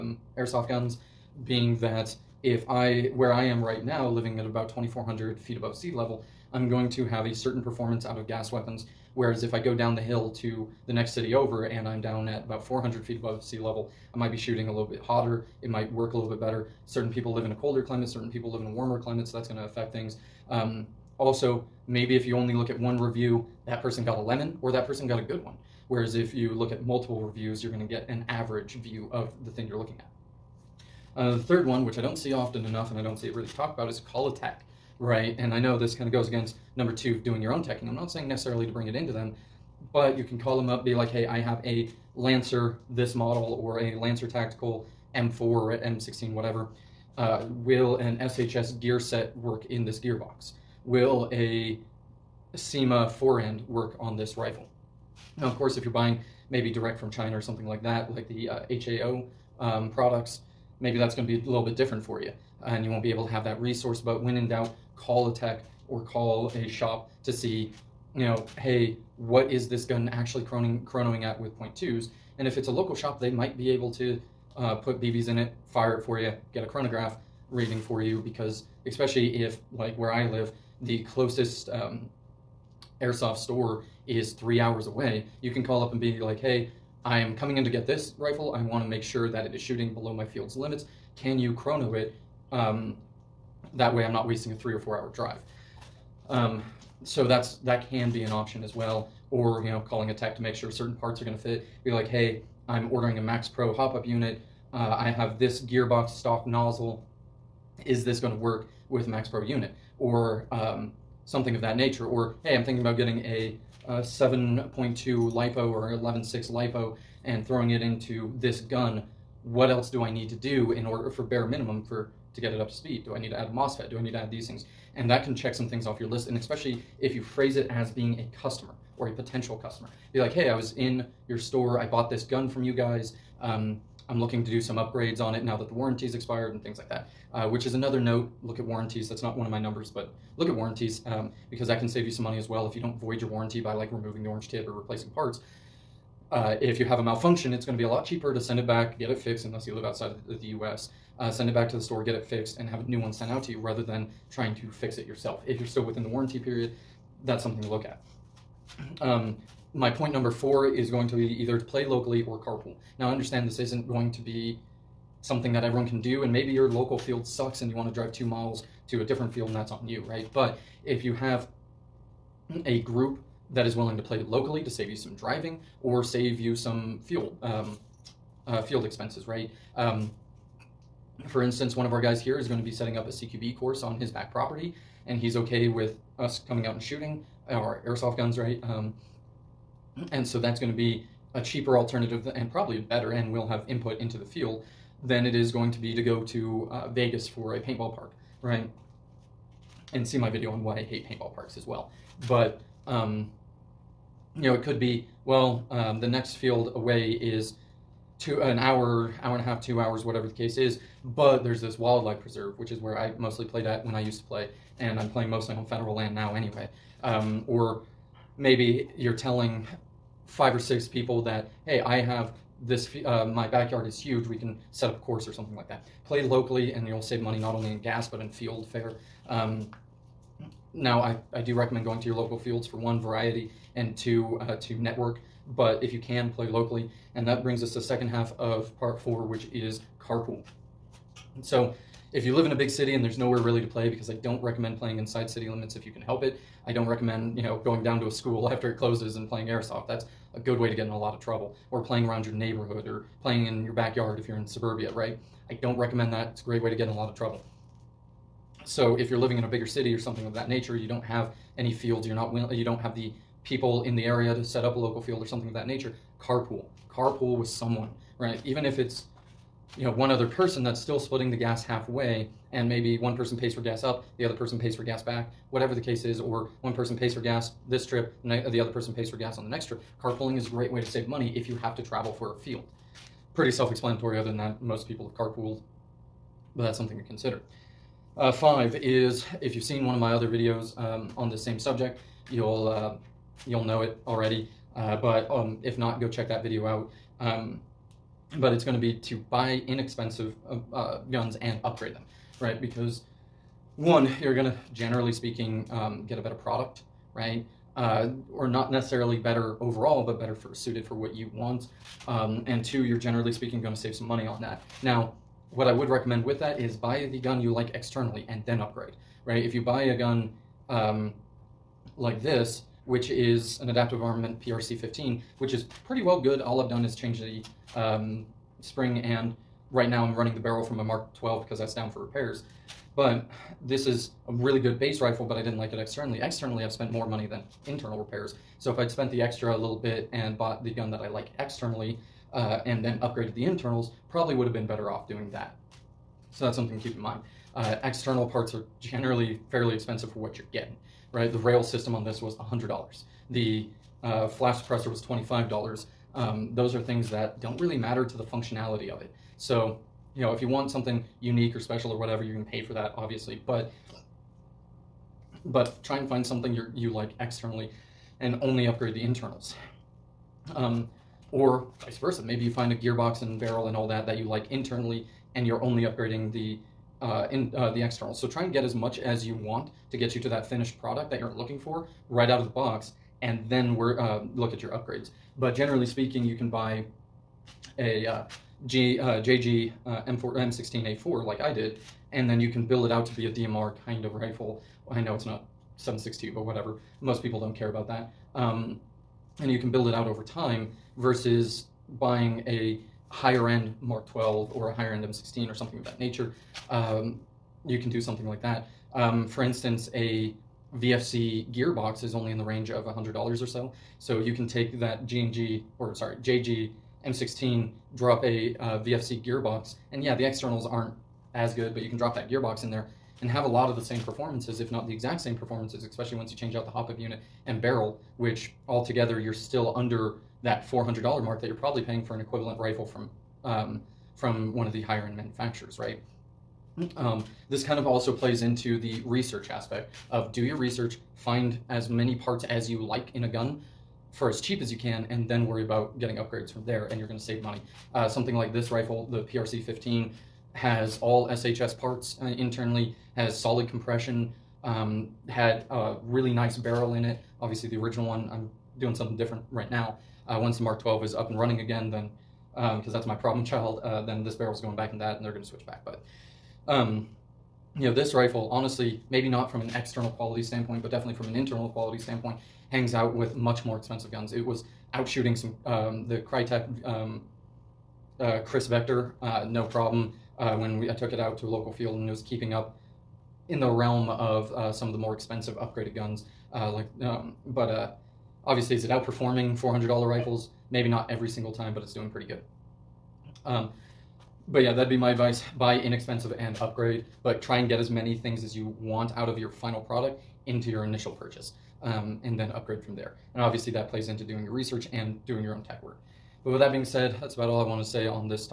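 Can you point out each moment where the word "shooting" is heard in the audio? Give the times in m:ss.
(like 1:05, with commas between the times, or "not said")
0:14, 1:29, 3:06, 7:55.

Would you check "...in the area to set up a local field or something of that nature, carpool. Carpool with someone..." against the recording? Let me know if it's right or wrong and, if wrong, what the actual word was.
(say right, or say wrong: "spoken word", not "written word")
right.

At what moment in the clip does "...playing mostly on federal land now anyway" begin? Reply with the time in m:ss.
3:35.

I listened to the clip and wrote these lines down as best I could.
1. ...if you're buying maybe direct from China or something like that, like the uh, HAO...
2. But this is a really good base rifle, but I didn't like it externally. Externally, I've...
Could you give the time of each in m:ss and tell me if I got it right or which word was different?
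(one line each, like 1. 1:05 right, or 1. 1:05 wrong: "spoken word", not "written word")
1. 0:55 right
2. 5:32 right.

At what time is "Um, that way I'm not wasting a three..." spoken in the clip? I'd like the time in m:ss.
1:32.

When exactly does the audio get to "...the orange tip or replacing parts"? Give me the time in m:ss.
2:24.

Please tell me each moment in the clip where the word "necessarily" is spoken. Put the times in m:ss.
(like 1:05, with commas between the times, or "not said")
0:38, 5:08.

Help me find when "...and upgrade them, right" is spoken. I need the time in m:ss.
5:01.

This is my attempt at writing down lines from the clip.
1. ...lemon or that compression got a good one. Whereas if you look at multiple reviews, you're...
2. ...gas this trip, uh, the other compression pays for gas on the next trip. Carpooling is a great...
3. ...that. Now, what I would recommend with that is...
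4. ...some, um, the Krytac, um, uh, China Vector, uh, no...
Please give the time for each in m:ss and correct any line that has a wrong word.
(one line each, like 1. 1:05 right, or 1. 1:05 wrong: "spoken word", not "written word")
1. 0:24 wrong: "person", not "compression"
2. 4:37 wrong: "person", not "compression"
3. 5:14 right
4. 7:55 wrong: "Kriss", not "China".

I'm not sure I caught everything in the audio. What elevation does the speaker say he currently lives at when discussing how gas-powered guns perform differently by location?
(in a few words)
2,400 feet.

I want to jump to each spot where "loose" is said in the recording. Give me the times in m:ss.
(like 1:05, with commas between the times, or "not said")
not said.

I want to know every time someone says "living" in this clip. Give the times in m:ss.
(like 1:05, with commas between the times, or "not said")
0:04, 4:19.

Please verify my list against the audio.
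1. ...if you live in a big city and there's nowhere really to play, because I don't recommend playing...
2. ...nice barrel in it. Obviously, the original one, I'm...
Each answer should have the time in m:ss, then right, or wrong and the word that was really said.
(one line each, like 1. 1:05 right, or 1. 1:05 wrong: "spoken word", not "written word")
1. 4:02 right
2. 7:36 right.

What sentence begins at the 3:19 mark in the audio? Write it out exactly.
and see my video on why I hate paintball parks as well.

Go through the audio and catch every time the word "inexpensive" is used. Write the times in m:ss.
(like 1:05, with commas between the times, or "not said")
4:59, 8:15.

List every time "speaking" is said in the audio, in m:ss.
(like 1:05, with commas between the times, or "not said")
5:05, 5:13, 6:25.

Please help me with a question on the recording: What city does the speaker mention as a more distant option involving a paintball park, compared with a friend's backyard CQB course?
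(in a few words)
Vegas.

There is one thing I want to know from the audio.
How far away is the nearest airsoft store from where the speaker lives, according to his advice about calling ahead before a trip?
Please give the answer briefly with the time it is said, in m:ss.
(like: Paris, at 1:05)
3 hours, at 1:24.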